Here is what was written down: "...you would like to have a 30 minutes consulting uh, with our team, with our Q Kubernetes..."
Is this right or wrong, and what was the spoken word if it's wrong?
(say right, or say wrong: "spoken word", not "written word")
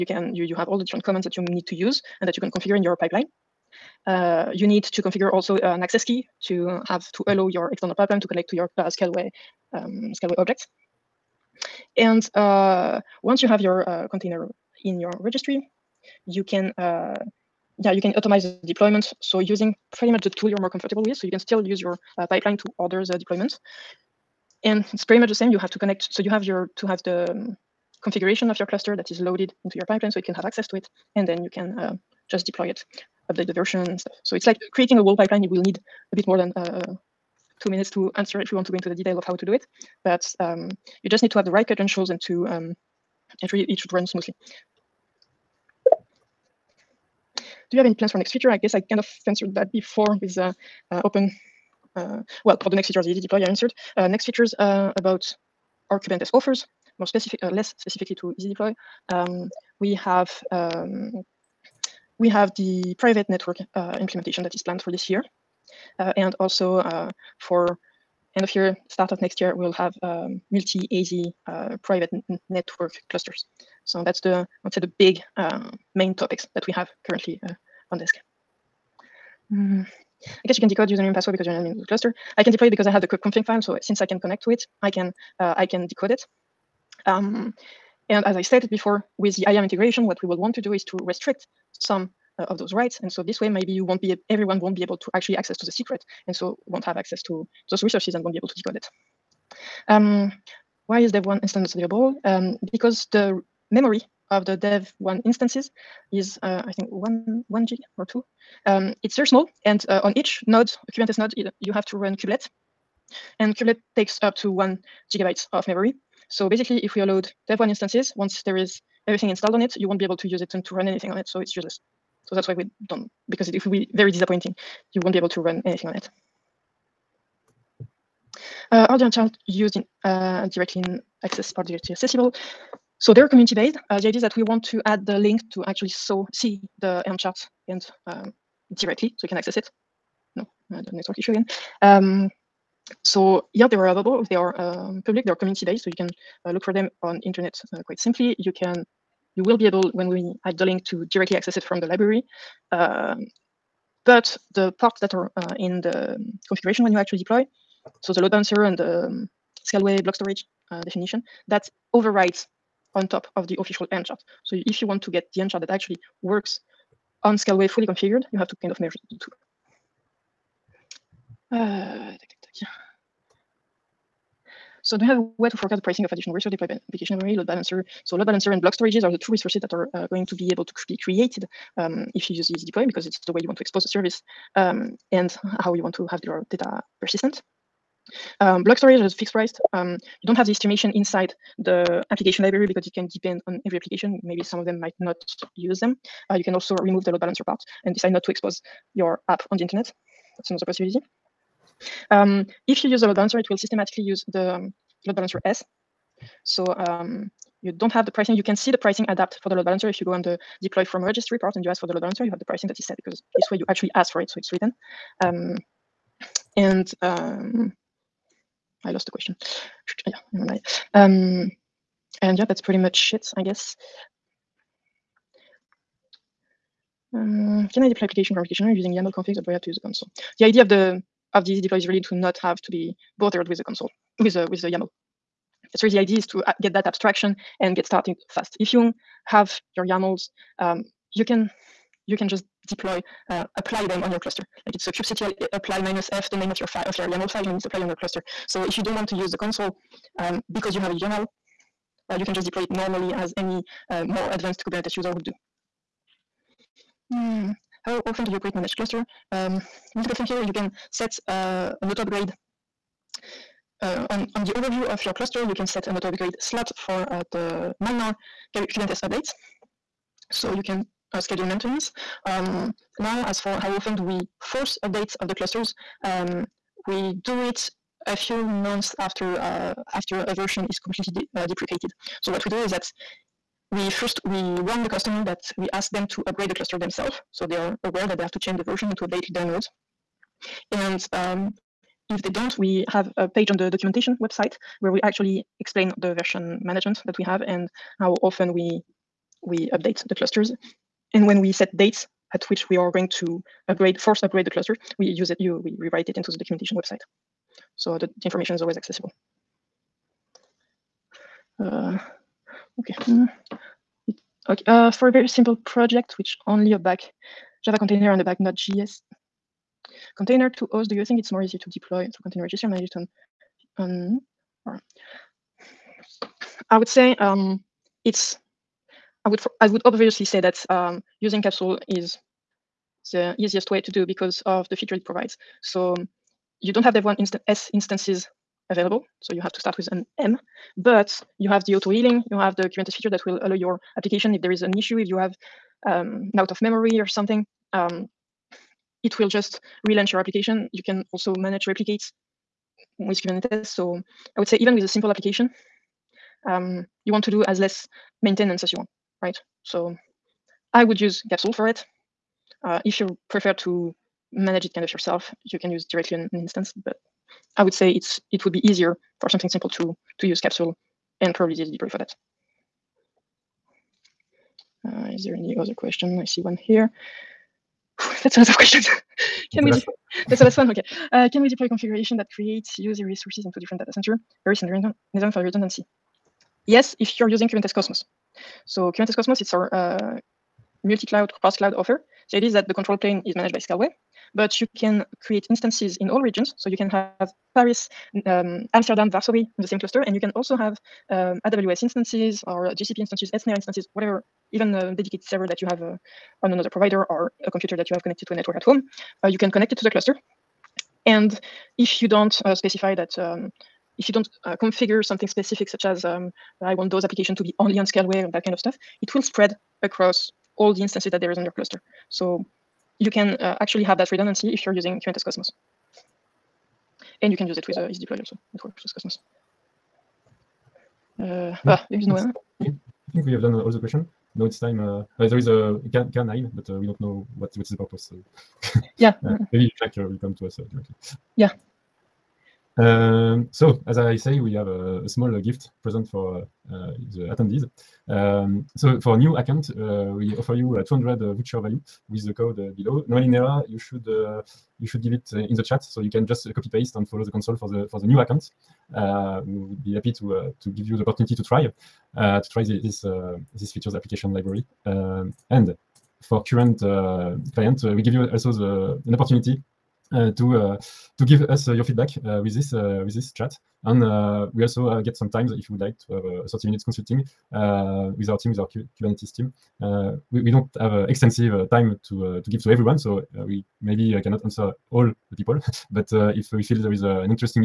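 right.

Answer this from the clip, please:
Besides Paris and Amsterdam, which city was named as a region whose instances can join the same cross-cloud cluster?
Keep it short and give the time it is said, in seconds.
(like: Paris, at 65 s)
Varsovie, at 399 s.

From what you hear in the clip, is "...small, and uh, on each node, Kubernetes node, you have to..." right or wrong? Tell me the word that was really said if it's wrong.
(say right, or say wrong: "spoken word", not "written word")
right.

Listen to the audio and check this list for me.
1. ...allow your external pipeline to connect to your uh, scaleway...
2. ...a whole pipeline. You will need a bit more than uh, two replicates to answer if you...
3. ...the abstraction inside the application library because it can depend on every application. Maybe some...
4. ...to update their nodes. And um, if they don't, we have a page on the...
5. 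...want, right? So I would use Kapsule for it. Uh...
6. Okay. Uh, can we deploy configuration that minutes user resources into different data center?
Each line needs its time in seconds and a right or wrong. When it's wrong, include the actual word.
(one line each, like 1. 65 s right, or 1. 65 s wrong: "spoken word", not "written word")
1. 7 s right
2. 34 s wrong: "minutes", not "replicates"
3. 190 s wrong: "estimation", not "abstraction"
4. 288 s right
5. 358 s right
6. 380 s wrong: "creates", not "minutes".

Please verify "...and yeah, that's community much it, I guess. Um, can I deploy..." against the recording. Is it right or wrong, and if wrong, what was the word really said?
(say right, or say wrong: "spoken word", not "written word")
wrong: "pretty", not "community".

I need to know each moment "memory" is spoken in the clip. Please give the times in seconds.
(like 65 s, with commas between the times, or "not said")
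103 s, 115 s, 177 s, 346 s.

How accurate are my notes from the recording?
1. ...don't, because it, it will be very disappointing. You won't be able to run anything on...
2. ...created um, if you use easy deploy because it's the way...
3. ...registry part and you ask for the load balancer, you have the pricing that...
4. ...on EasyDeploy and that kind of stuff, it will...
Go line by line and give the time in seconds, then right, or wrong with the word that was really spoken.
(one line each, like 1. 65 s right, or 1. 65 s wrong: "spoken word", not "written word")
1. 122 s right
2. 180 s right
3. 211 s right
4. 417 s wrong: "Scaleway", not "EasyDeploy".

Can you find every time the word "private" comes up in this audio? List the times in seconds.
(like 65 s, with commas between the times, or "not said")
62 s, 71 s.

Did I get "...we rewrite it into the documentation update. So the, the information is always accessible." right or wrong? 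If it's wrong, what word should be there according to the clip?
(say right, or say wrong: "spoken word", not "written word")
wrong: "website", not "update".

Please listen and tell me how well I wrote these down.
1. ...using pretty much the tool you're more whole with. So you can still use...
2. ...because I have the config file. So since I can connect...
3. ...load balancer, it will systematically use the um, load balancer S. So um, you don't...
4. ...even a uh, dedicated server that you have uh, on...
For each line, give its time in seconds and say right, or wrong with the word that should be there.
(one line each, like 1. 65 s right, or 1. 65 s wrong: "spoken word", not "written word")
1. 19 s wrong: "comfortable", not "whole"
2. 82 s right
3. 203 s right
4. 404 s right.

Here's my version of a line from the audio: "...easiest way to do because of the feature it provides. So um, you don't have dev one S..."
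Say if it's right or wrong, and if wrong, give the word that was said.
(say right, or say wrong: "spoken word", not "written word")
right.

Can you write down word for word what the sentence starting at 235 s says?
That's really the idea is to uh, get that abstraction and get started fast.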